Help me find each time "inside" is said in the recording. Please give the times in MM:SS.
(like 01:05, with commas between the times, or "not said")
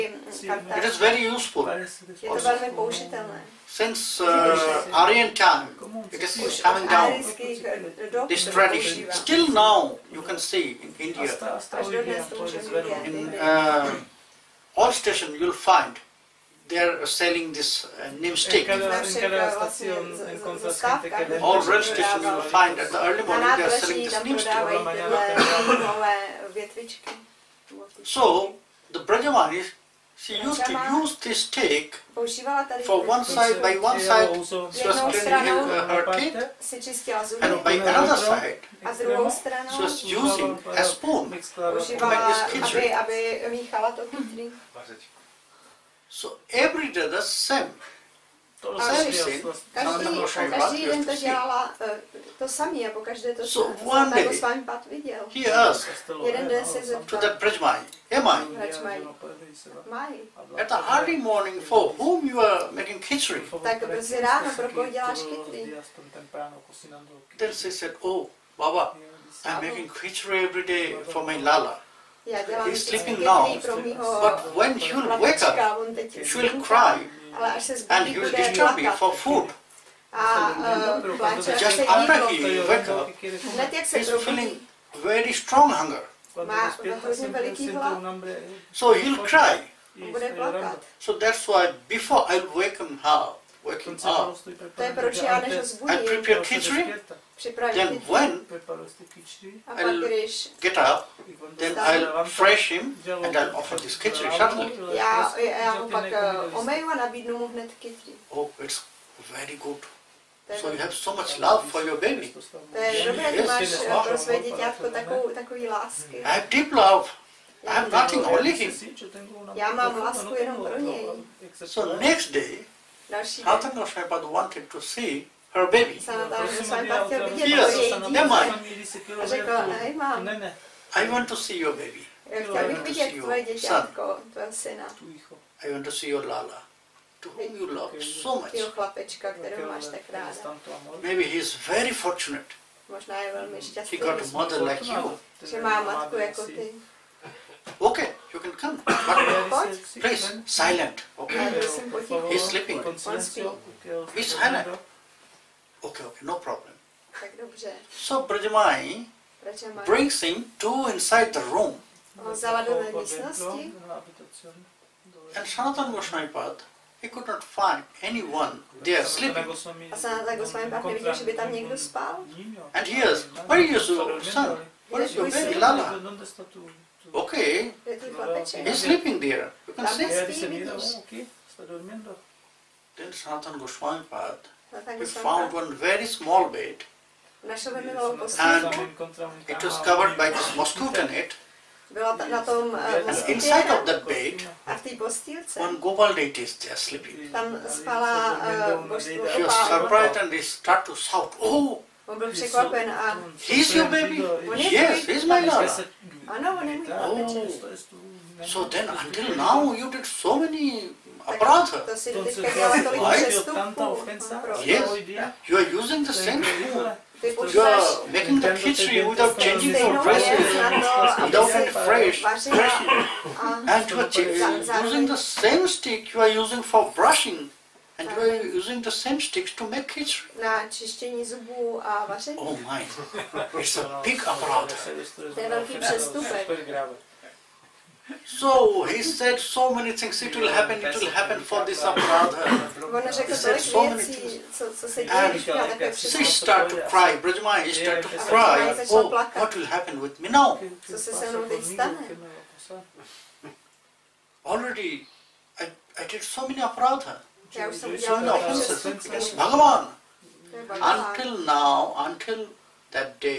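02:40, 03:13.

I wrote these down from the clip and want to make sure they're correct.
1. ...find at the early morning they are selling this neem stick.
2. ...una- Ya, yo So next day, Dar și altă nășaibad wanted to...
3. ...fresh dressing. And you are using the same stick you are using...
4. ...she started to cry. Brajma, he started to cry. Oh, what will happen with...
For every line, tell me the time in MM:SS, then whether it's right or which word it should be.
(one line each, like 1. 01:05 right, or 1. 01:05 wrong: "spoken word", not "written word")
1. 00:22 right
2. 01:59 right
3. 03:41 right
4. 04:05 right.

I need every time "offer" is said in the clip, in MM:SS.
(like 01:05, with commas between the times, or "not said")
01:43.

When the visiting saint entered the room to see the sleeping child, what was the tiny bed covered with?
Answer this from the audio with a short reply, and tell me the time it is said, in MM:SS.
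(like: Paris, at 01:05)
Mosquito net, at 03:10.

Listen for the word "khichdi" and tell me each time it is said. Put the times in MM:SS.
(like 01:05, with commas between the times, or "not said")
00:42, 01:03, 01:09, 01:36, 01:43, 03:38, 03:49.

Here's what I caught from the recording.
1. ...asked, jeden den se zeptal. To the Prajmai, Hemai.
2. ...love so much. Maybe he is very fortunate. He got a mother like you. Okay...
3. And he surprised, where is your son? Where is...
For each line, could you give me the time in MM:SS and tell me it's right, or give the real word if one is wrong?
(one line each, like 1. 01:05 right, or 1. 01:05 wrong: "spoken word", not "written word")
1. 00:55 right
2. 02:17 right
3. 02:52 wrong: "asked", not "surprised".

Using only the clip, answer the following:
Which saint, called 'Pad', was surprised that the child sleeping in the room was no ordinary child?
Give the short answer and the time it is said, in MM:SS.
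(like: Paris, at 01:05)
Sanatana Goswami, at 02:45.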